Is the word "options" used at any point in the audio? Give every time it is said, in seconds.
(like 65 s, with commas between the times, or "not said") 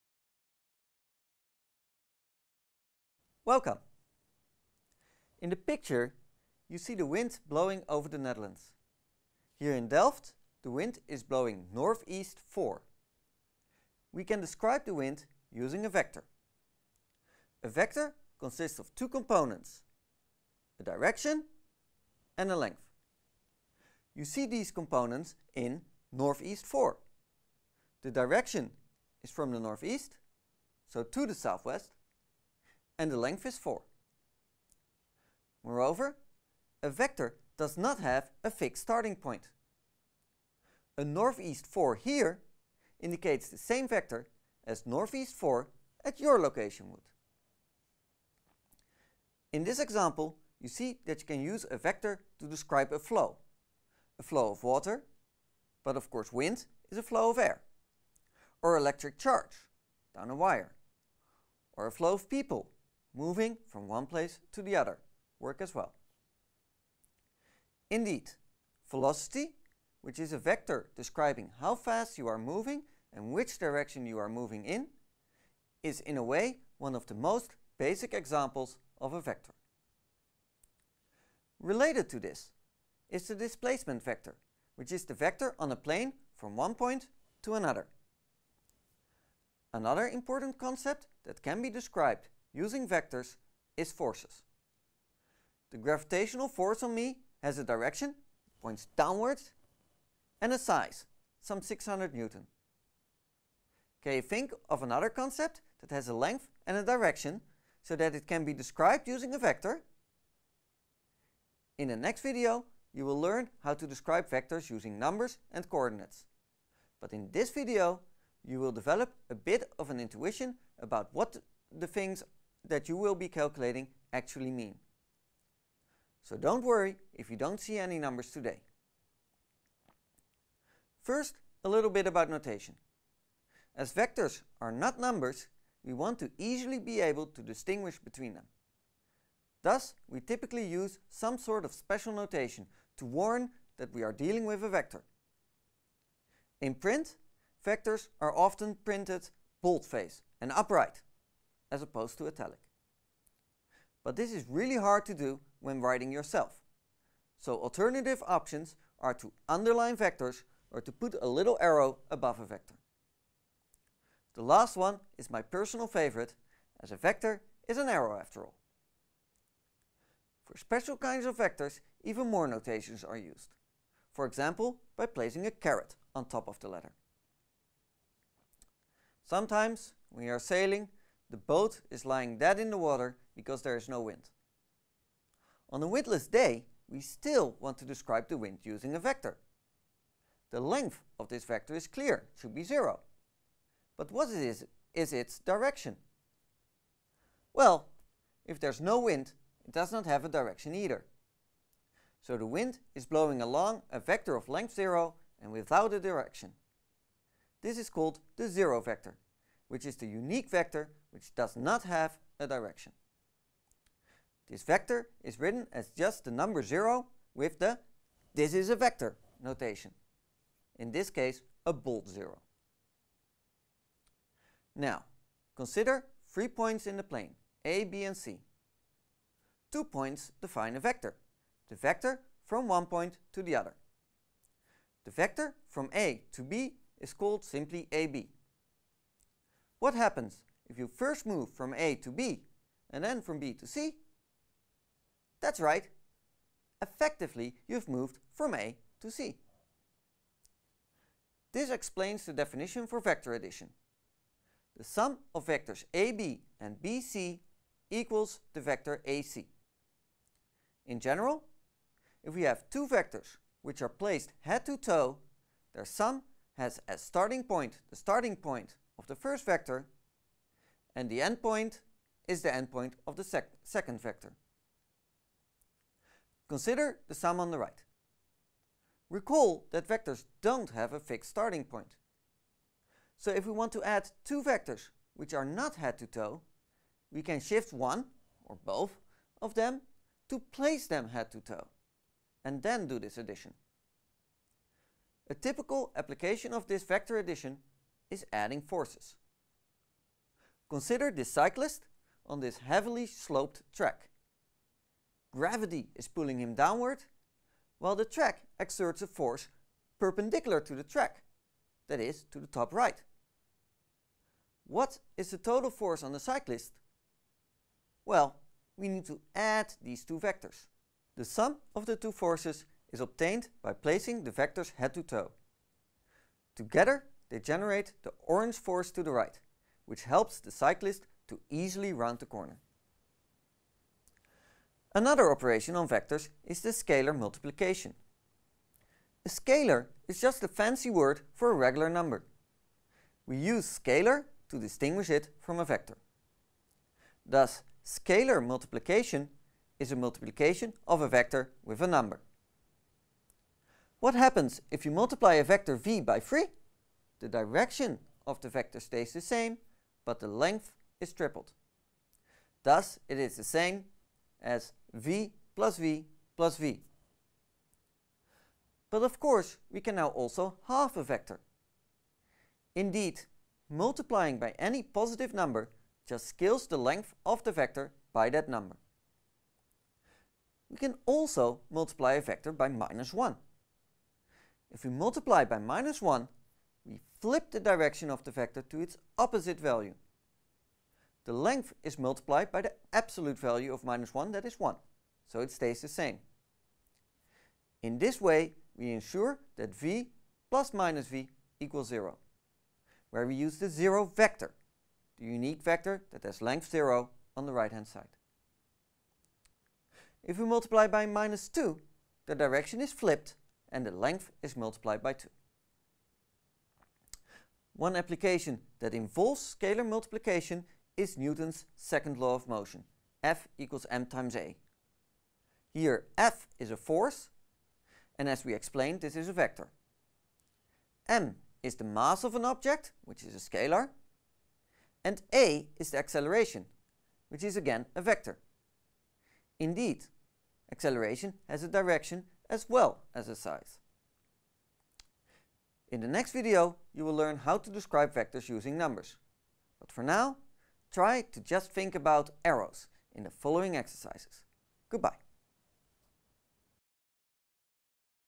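158 s.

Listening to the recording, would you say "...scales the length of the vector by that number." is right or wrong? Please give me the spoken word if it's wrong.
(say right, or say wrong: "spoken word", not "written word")
right.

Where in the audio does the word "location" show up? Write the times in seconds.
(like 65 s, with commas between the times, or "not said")
46 s.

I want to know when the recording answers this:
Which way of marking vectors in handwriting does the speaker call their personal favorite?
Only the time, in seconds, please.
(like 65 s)
161 s.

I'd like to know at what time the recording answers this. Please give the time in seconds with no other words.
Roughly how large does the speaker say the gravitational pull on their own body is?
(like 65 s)
101 s.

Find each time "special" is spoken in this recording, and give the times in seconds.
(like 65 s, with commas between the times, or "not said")
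141 s, 170 s.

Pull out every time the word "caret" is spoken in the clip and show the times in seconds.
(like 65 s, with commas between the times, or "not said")
175 s.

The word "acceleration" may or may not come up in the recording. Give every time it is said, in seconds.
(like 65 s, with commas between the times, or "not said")
435 s, 440 s.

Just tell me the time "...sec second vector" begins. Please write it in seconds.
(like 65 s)
273 s.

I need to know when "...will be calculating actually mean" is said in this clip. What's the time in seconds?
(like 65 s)
122 s.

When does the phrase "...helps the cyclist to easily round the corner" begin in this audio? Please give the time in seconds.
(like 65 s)
330 s.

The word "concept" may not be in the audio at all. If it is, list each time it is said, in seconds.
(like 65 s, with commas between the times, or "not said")
90 s, 105 s.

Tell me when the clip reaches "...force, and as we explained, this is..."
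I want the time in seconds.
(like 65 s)
426 s.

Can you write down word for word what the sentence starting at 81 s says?
Related to this is the displacement vector, which is the vector on a plane from one point to another.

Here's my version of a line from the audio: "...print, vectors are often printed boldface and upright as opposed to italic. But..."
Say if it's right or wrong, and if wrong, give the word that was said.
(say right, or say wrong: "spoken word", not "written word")
right.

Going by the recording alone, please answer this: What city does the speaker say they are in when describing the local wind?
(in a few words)
Delft.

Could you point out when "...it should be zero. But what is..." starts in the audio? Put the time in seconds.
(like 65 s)
192 s.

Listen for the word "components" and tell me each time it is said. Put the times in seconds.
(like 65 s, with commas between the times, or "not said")
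19 s, 24 s.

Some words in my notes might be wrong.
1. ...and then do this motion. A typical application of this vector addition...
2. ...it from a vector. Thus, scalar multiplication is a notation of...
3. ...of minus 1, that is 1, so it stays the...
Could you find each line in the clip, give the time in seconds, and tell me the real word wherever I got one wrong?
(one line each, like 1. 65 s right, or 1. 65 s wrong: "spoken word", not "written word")
1. 292 s wrong: "addition", not "motion"
2. 345 s wrong: "multiplication", not "notation"
3. 393 s right.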